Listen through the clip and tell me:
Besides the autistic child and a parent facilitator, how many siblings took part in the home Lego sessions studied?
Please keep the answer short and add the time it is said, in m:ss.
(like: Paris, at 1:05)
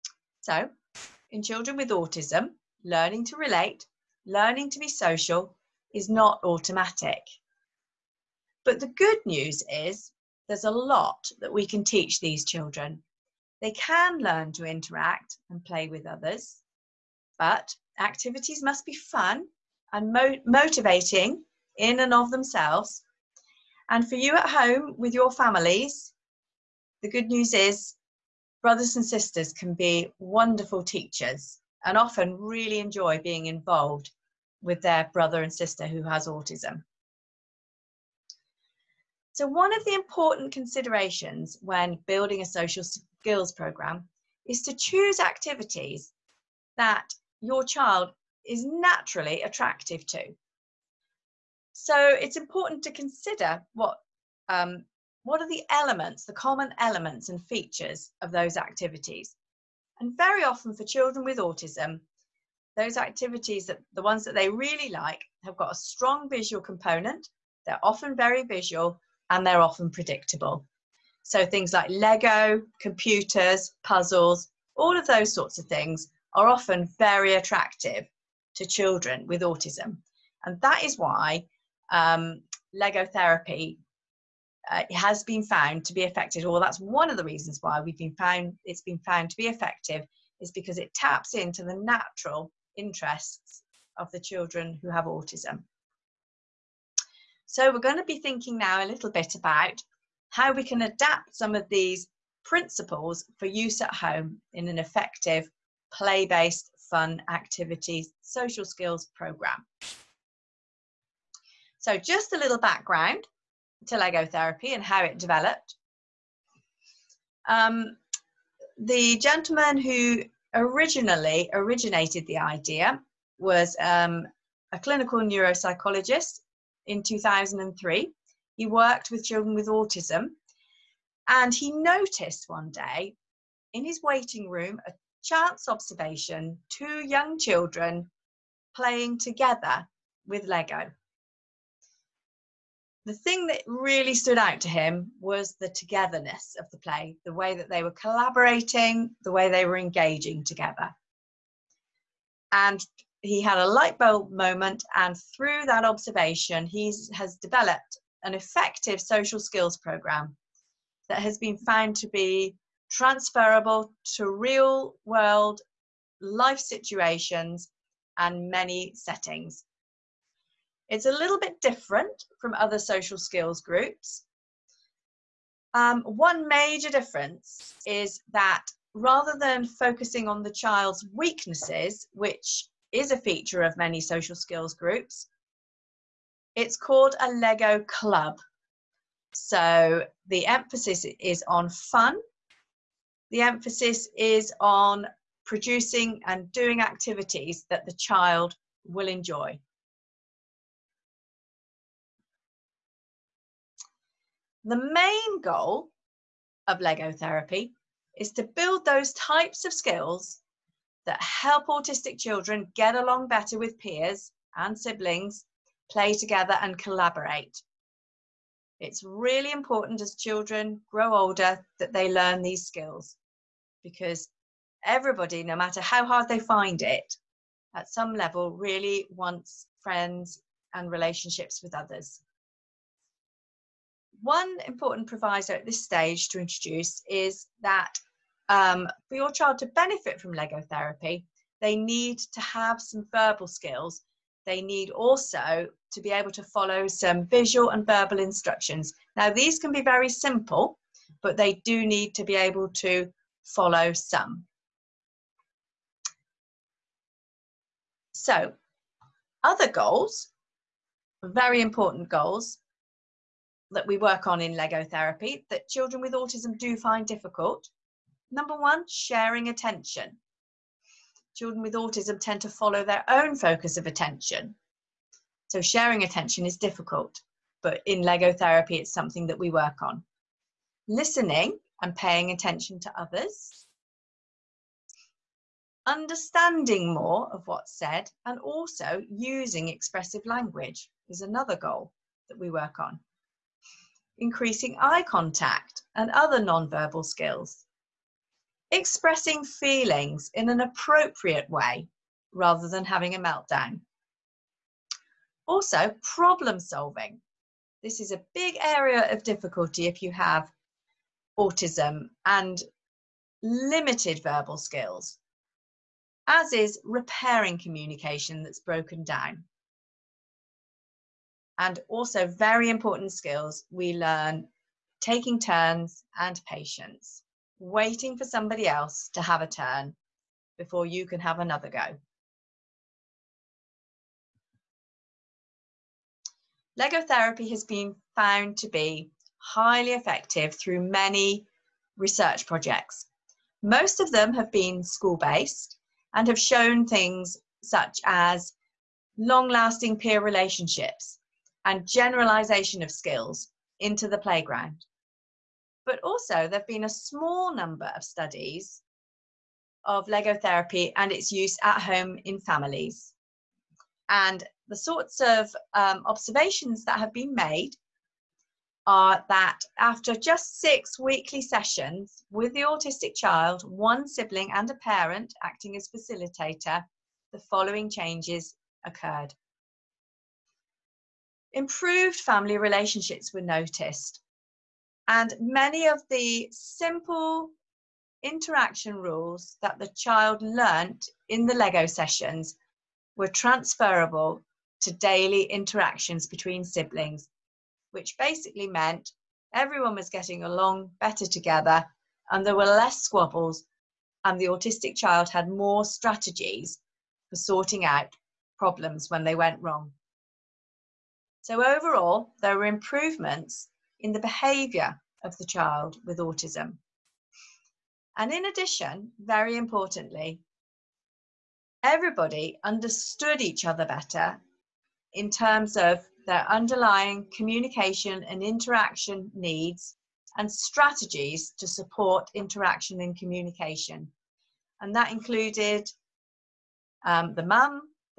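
1, at 6:13.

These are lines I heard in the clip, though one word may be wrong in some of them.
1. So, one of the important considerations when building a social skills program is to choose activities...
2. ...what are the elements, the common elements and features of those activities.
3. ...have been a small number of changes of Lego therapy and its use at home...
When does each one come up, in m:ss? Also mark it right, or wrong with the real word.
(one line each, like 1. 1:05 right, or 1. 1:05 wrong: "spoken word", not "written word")
1. 0:39 right
2. 0:55 right
3. 5:56 wrong: "studies", not "changes".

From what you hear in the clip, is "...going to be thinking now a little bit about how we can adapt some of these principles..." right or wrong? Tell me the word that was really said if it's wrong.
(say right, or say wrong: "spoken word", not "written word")
right.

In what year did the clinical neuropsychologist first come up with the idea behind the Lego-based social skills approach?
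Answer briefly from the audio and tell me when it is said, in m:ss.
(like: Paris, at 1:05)
2003, at 2:07.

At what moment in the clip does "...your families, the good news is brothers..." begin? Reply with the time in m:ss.
0:25.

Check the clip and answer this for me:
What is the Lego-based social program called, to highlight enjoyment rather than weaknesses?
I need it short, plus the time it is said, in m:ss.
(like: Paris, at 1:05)
Lego club, at 3:07.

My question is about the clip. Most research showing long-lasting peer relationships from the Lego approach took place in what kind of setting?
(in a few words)
School based.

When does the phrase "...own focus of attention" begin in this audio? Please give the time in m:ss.
4:33.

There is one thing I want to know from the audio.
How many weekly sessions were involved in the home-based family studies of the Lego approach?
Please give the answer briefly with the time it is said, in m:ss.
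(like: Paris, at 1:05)
6, at 6:10.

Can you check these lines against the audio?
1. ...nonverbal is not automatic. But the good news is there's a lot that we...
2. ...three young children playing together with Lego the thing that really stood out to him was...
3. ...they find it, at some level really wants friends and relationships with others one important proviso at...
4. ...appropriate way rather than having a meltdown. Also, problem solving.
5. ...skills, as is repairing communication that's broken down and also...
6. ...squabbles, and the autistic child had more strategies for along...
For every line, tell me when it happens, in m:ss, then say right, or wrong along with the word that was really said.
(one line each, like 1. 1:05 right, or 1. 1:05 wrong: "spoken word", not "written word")
1. 0:04 wrong: "social", not "nonverbal"
2. 2:16 wrong: "two", not "three"
3. 3:46 right
4. 5:00 right
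5. 5:14 right
6. 6:43 wrong: "sorting", not "along".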